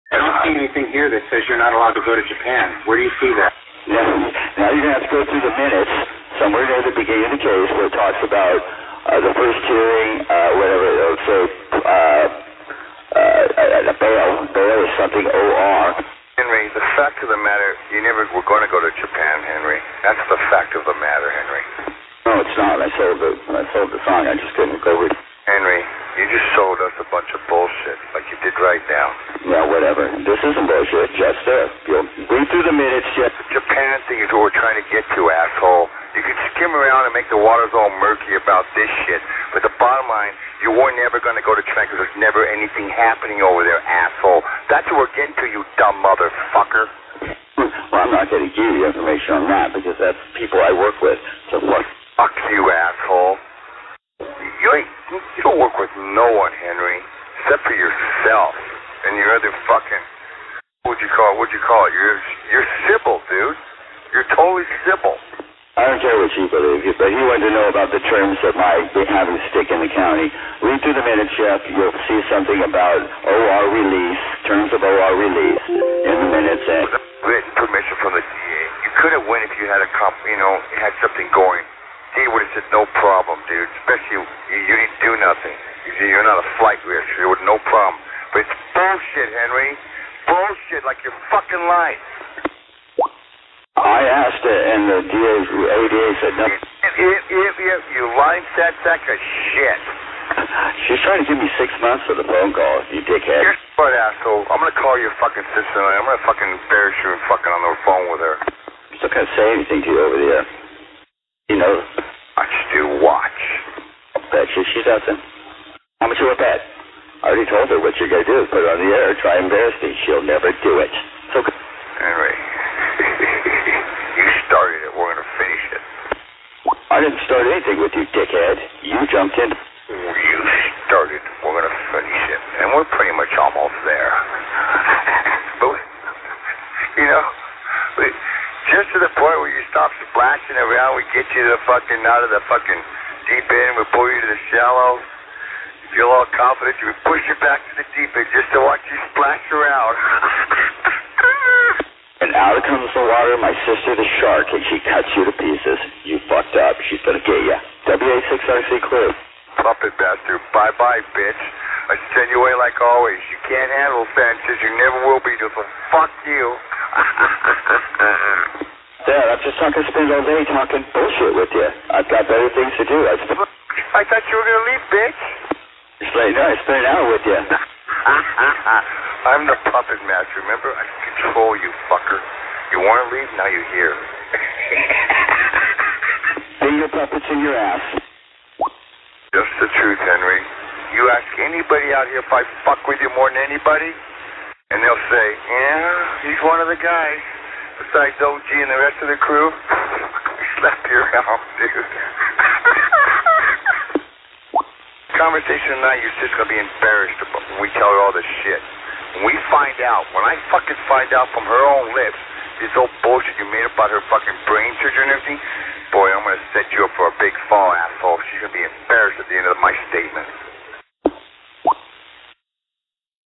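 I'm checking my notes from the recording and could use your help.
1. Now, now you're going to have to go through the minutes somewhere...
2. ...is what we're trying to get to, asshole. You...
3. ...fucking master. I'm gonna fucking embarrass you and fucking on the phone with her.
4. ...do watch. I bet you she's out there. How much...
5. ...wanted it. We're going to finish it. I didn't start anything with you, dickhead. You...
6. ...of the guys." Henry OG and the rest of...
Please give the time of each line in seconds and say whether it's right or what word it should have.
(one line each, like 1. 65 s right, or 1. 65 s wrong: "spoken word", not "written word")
1. 3 s right
2. 34 s right
3. 105 s wrong: "sister", not "master"
4. 112 s right
5. 124 s wrong: "started", not "wanted"
6. 196 s wrong: "Besides", not "Henry".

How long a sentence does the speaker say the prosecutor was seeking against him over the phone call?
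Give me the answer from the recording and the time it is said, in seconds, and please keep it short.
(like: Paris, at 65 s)
6 months, at 101 s.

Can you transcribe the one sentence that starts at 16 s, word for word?
Henry, the fact of the matter, you never were going to go to Japan, Henry.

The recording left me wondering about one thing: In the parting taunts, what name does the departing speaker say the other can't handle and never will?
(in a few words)
Sanchez.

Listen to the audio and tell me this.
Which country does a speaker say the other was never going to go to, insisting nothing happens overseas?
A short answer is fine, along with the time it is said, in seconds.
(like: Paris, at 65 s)
China, at 41 s.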